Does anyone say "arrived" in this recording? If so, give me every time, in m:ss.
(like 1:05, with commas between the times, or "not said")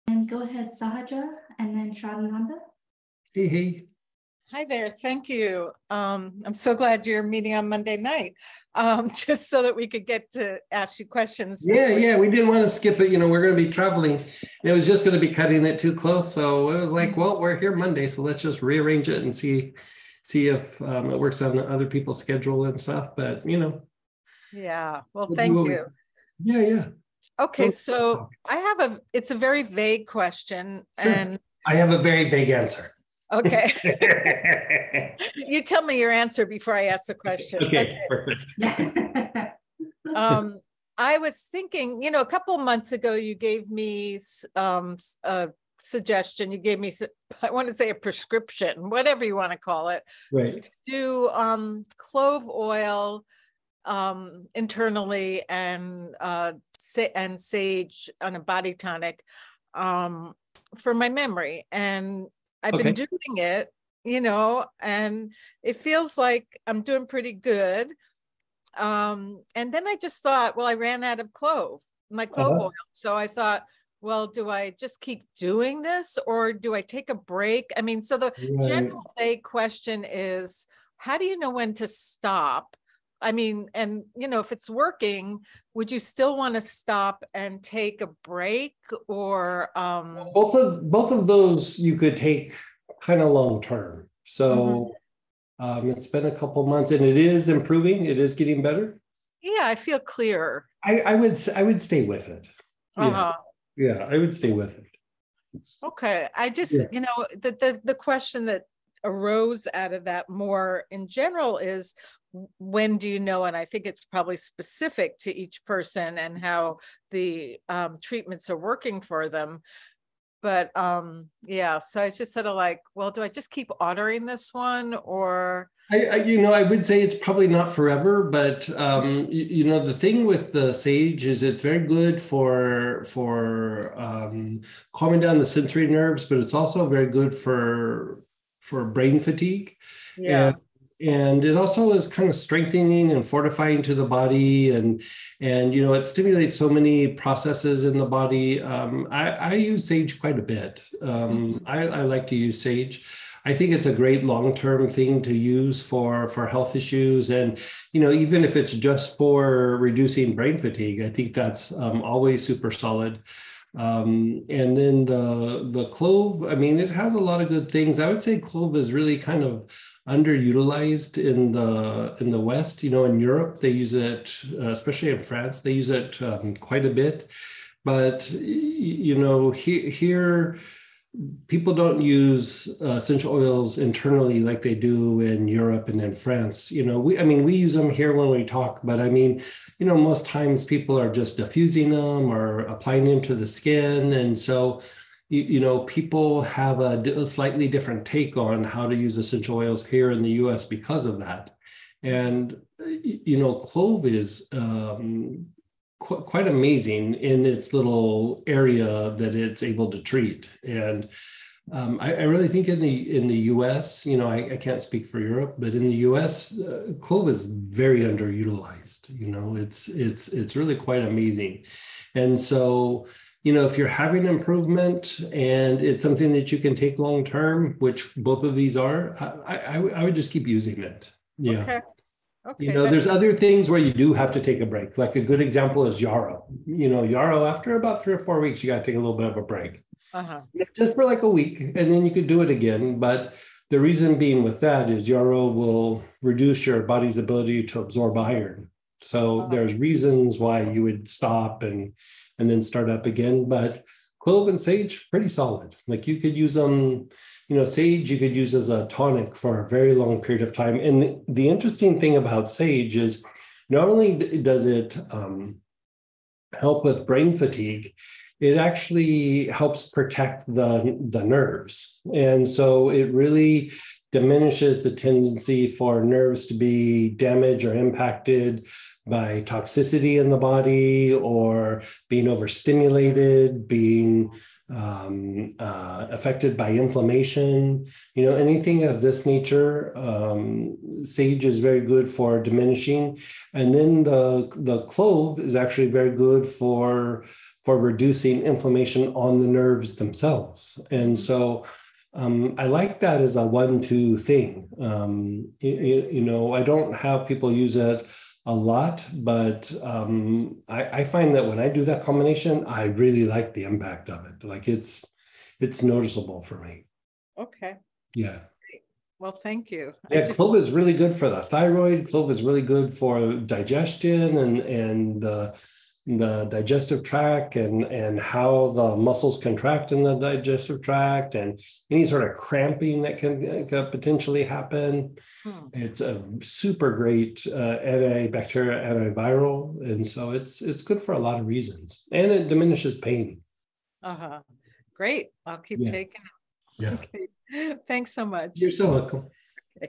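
not said.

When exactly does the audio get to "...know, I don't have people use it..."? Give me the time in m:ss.
5:06.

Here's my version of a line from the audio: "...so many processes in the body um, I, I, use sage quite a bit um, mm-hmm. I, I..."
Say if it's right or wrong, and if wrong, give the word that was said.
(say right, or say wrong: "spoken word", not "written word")
right.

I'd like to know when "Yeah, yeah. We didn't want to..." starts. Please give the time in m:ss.
0:11.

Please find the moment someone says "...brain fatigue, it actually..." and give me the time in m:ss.
4:27.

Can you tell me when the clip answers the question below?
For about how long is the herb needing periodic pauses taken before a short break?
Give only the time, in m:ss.
3:58.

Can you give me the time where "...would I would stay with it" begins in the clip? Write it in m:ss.
1:41.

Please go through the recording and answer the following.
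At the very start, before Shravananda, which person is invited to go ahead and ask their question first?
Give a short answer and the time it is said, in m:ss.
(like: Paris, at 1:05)
Sahaja, at 0:00.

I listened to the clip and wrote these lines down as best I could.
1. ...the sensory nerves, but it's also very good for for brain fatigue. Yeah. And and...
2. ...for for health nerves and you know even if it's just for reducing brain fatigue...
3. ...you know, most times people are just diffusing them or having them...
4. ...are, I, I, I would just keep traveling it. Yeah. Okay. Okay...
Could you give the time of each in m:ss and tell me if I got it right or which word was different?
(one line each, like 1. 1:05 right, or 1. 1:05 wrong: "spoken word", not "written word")
1. 2:15 right
2. 2:35 wrong: "issues", not "nerves"
3. 3:09 wrong: "applying", not "having"
4. 3:48 wrong: "using", not "traveling".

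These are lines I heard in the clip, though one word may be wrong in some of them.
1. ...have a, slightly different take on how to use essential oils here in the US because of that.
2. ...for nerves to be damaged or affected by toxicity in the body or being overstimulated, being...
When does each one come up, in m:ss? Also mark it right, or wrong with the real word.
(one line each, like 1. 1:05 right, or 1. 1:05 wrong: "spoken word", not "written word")
1. 3:16 right
2. 4:35 wrong: "impacted", not "affected".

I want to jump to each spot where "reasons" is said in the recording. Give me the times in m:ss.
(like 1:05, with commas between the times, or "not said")
4:03, 4:09, 5:41.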